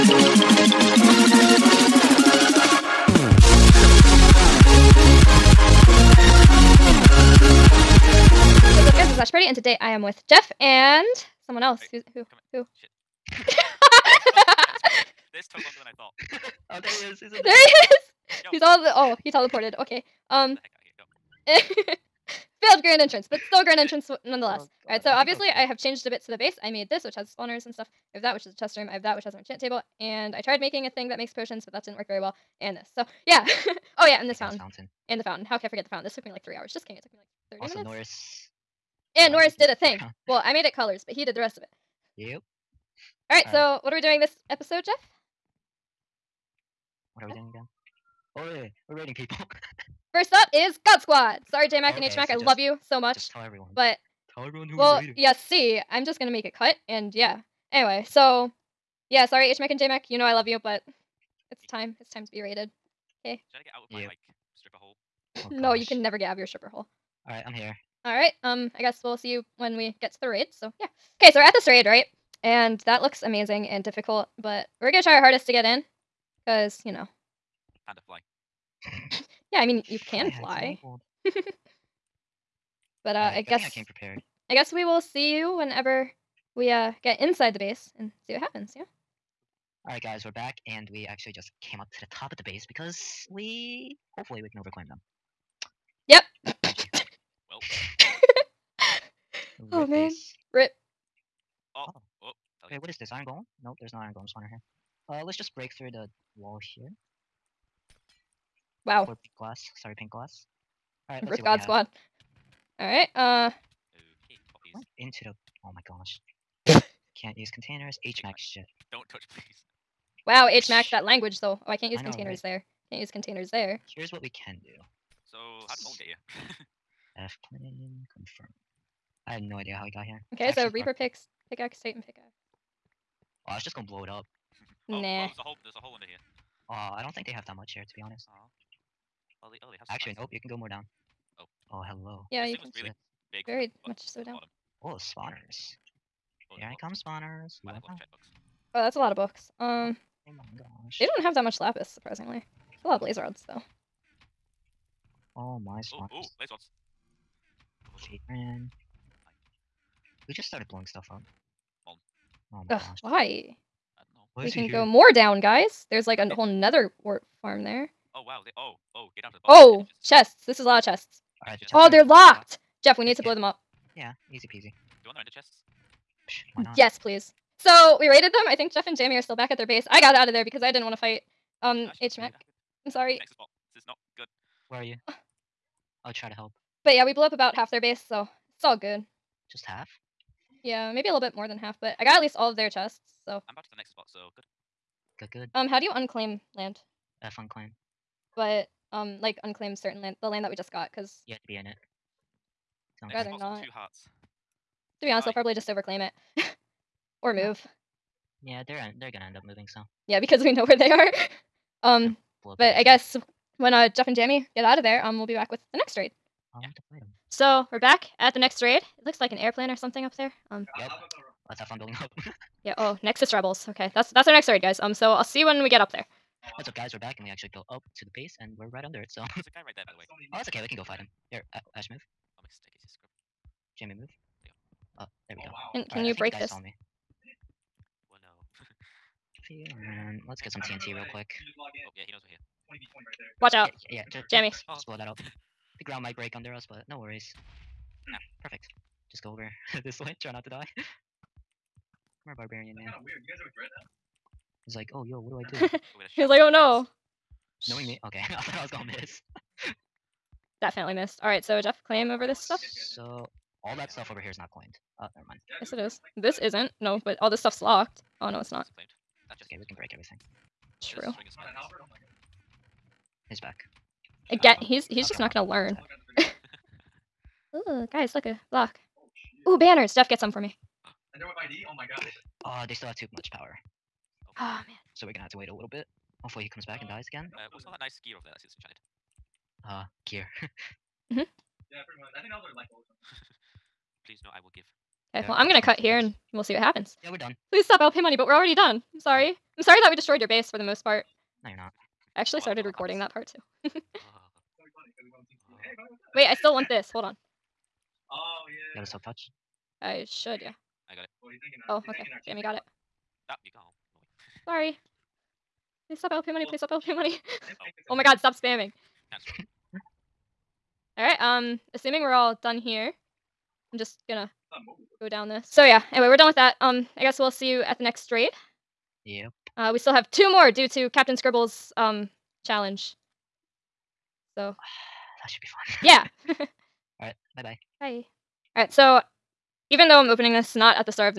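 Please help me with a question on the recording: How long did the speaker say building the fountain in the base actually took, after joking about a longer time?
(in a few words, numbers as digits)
30 minutes.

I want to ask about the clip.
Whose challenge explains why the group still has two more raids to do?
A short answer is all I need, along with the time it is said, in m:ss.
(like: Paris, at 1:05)
Captain Scribble, at 5:30.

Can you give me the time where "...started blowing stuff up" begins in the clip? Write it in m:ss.
2:40.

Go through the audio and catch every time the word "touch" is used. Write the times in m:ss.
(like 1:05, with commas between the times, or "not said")
1:59, 5:09.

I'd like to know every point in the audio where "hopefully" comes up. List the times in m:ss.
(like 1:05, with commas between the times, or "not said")
1:34, 4:46.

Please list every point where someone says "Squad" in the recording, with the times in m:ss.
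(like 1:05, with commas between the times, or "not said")
0:50, 1:51.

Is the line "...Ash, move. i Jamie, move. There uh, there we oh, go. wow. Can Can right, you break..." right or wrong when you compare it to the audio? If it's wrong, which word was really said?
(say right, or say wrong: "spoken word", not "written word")
right.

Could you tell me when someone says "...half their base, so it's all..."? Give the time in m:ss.
3:07.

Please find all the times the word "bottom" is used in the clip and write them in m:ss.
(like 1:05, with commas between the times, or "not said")
2:24, 2:49.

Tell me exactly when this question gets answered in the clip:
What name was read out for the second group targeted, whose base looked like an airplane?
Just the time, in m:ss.
3:43.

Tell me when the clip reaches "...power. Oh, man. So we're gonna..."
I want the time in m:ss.
4:43.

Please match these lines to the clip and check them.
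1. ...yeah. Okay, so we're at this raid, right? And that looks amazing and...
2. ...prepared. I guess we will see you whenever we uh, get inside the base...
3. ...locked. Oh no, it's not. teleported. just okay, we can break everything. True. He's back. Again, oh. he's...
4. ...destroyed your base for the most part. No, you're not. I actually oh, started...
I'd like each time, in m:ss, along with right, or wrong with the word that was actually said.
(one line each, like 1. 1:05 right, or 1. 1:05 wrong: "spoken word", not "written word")
1. 1:10 right
2. 1:23 right
3. 4:27 wrong: "claimed", not "teleported"
4. 4:59 right.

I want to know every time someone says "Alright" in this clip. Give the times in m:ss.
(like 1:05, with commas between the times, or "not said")
0:24, 1:08, 5:38.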